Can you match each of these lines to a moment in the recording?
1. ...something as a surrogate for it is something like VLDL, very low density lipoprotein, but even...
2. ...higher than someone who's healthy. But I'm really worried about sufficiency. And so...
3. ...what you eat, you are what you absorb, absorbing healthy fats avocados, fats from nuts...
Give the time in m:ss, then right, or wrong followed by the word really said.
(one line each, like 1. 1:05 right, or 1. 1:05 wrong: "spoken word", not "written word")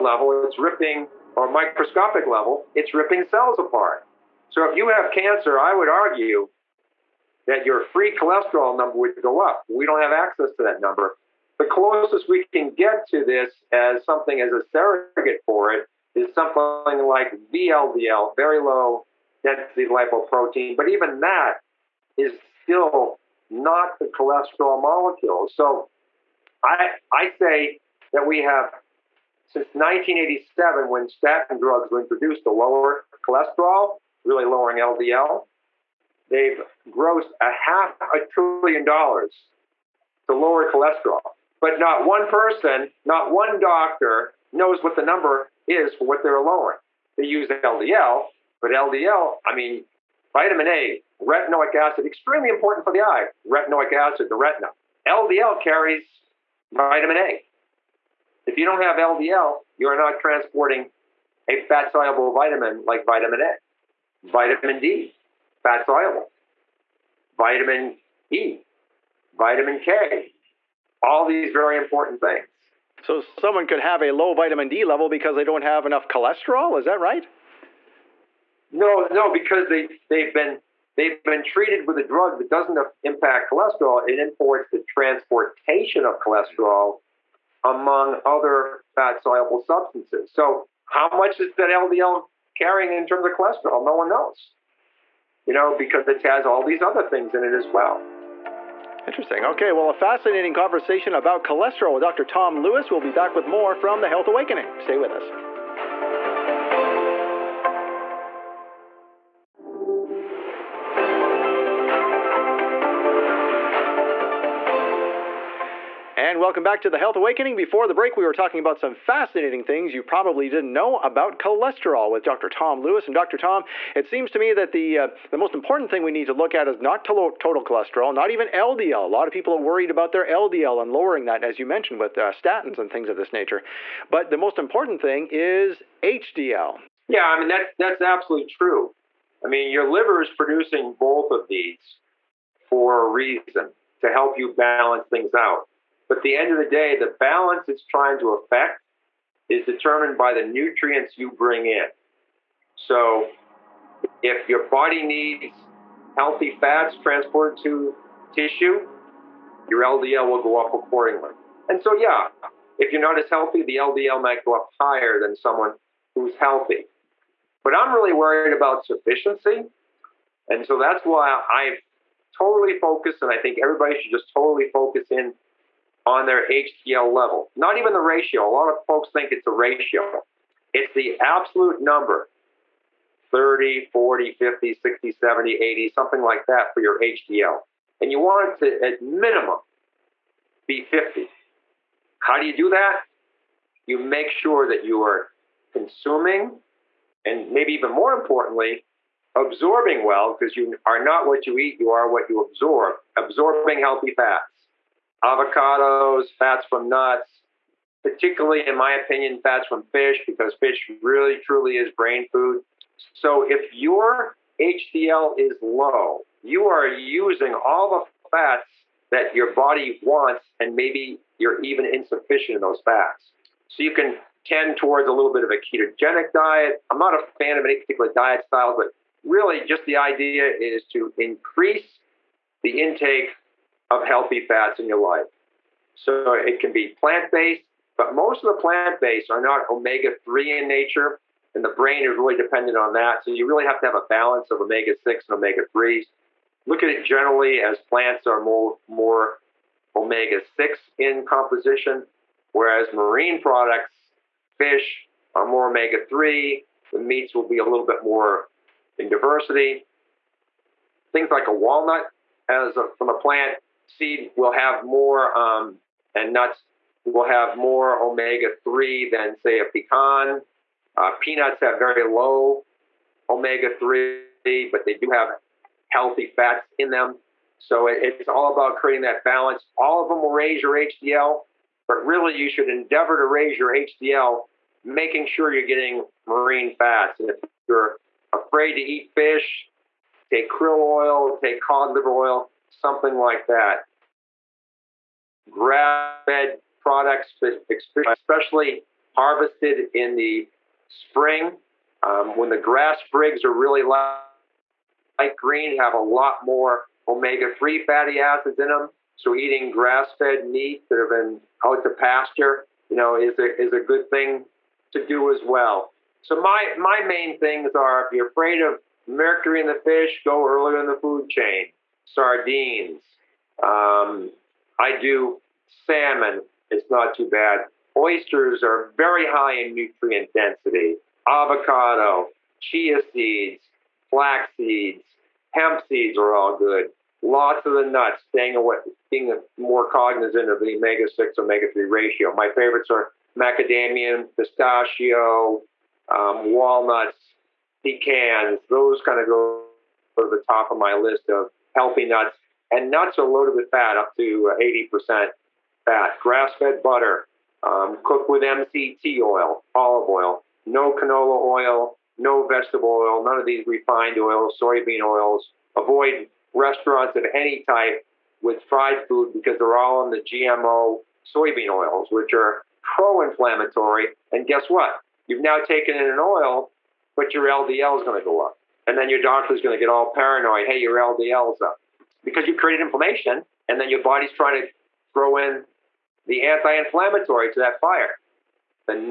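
1. 0:14 right
2. 2:44 right
3. 3:21 right.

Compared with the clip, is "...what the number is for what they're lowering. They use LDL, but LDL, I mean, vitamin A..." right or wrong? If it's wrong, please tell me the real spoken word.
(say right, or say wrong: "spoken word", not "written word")
right.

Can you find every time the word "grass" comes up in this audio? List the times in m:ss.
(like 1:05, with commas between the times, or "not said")
4:55, 5:02, 5:09, 5:56.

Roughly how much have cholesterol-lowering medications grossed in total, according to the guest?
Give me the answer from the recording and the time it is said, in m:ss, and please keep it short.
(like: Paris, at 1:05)
half a trillion dollars, at 0:37.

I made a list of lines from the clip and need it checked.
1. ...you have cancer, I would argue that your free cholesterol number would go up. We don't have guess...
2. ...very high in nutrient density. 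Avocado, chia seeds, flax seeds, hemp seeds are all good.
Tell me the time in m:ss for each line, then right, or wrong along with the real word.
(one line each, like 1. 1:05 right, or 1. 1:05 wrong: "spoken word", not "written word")
1. 0:04 wrong: "access", not "guess"
2. 5:28 right.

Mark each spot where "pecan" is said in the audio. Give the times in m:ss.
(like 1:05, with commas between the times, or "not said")
4:29, 5:47.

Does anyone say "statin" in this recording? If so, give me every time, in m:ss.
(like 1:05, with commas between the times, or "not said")
0:31, 2:12.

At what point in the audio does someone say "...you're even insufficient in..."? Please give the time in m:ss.
3:41.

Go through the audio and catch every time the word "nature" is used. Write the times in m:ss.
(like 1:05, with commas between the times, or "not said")
2:13, 4:00.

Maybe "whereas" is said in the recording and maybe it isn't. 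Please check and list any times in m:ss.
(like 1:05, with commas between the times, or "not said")
4:12.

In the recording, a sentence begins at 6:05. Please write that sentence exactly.
Avoid restaurants of any type with fried food because they're all in the GMO soybean oils, which are pro inflammatory.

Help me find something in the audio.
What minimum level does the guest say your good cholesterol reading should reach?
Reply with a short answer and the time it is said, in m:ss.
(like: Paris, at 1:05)
50, at 3:08.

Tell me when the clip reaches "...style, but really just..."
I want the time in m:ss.
3:48.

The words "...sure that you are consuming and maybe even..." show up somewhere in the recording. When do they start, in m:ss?
3:14.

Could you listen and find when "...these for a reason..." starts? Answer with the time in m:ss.
2:21.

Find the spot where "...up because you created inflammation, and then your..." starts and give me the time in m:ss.
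6:21.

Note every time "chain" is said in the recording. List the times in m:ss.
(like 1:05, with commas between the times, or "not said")
5:21.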